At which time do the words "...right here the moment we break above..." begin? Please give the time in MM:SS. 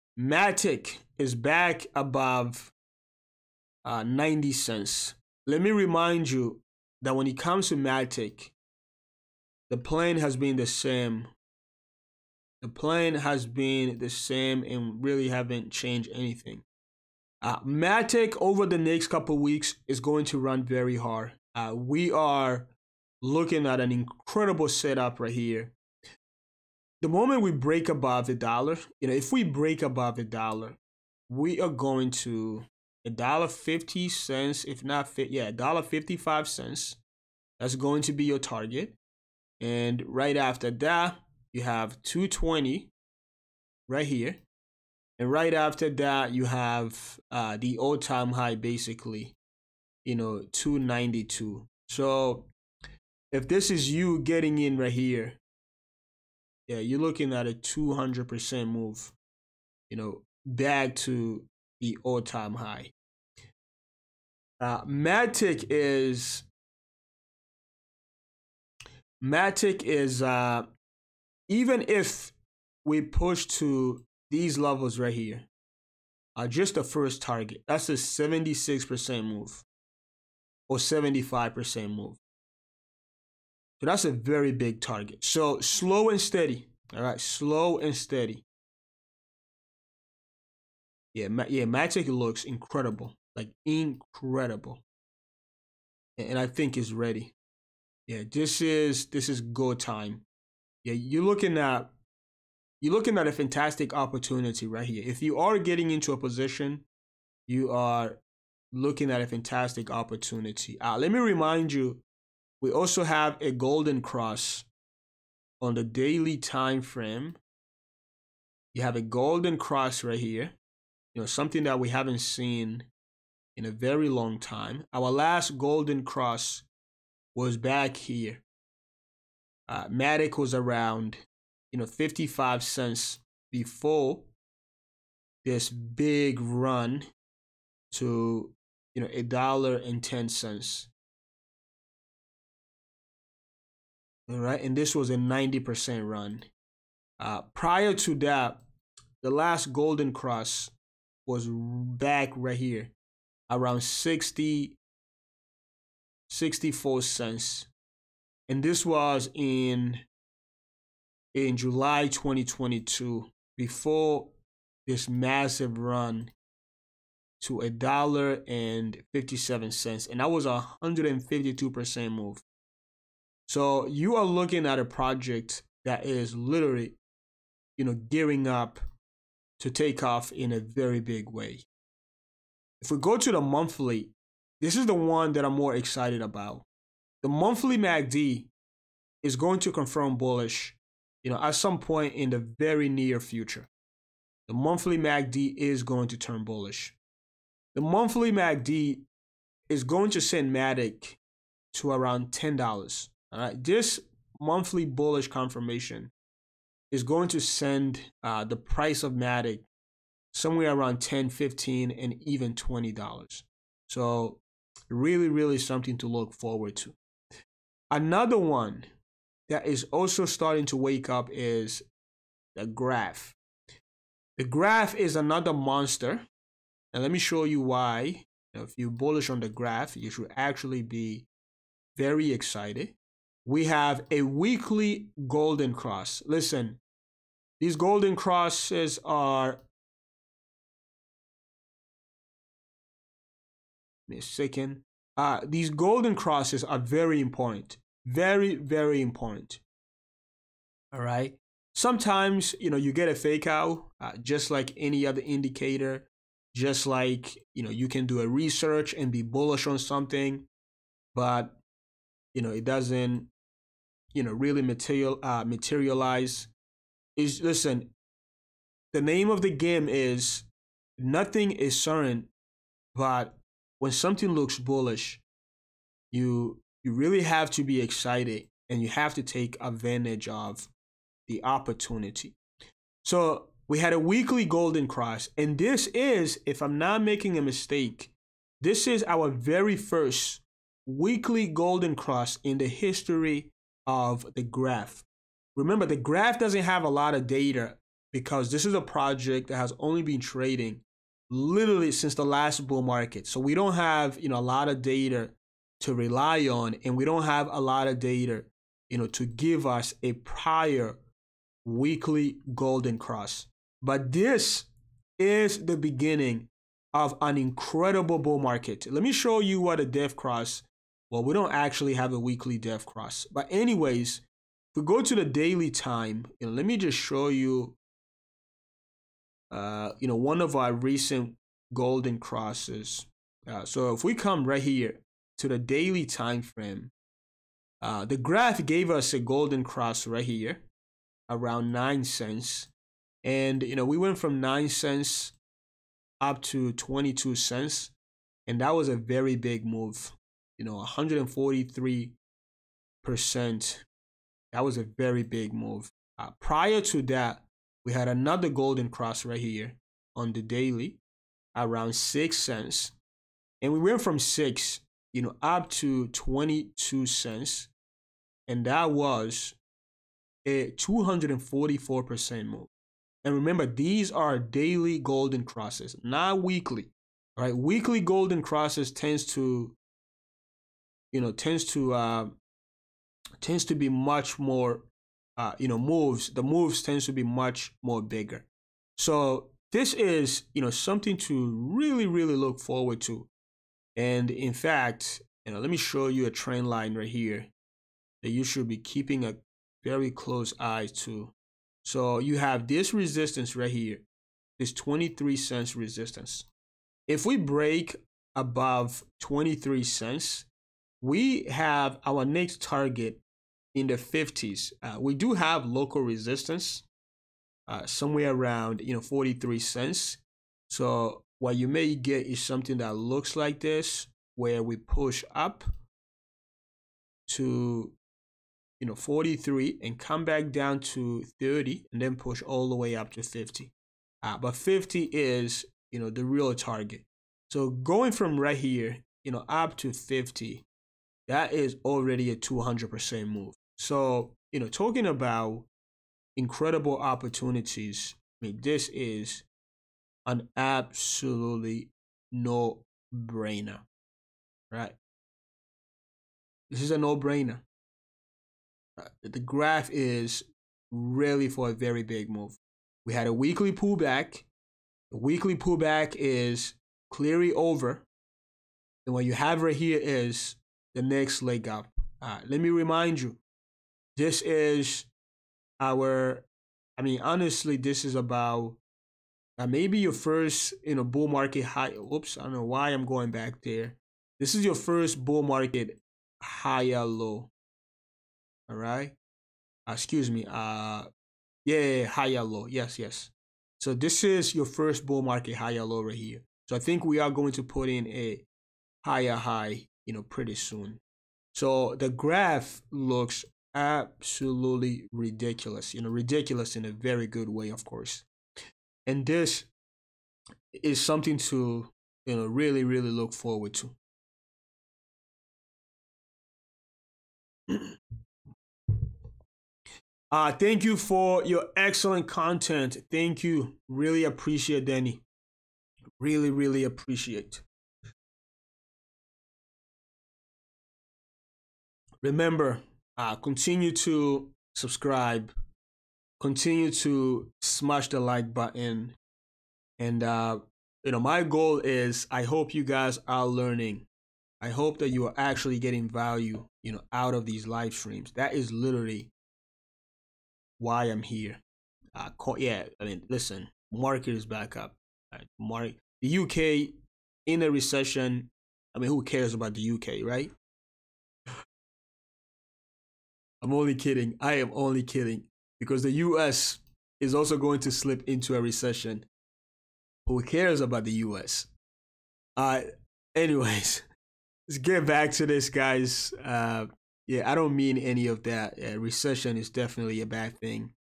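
00:25.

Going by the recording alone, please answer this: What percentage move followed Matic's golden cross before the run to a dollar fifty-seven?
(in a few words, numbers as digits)
152%.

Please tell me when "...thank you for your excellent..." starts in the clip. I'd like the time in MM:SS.
08:40.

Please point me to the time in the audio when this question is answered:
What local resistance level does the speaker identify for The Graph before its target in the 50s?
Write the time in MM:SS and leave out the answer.
06:59.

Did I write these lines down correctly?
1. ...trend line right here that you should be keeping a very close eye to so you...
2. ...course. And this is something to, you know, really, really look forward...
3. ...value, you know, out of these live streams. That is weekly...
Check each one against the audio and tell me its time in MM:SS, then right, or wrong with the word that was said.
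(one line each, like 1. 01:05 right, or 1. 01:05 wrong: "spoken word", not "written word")
1. 06:36 right
2. 08:27 right
3. 09:06 wrong: "literally", not "weekly".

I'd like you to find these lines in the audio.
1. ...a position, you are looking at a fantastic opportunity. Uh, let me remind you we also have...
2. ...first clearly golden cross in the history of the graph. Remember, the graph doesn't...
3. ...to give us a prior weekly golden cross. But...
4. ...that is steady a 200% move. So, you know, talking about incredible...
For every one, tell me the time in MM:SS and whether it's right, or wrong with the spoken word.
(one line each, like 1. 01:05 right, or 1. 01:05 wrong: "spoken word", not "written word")
1. 01:46 right
2. 04:49 wrong: "weekly", not "clearly"
3. 05:09 right
4. 07:21 wrong: "already", not "steady".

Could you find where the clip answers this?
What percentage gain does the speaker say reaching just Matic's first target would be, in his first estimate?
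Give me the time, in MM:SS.
01:17.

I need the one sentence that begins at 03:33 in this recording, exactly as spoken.
So really, really something to look forward to.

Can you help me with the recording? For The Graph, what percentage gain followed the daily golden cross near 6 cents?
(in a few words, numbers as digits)
244%.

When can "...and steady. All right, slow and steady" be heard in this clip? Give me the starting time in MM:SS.
01:26.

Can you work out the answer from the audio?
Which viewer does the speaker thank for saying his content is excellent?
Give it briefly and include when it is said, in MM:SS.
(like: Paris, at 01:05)
Danny, at 08:44.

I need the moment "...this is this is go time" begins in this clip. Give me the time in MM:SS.
01:38.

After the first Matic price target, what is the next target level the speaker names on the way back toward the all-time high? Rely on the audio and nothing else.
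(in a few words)
2.20.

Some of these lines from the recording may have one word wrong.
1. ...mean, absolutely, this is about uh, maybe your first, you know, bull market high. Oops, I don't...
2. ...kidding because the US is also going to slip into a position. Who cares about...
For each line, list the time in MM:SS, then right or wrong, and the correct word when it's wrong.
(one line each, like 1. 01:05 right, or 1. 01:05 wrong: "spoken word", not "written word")
1. 07:57 wrong: "honestly", not "absolutely"
2. 09:25 wrong: "recession", not "position".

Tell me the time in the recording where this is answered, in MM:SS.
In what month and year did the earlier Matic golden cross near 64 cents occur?
02:41.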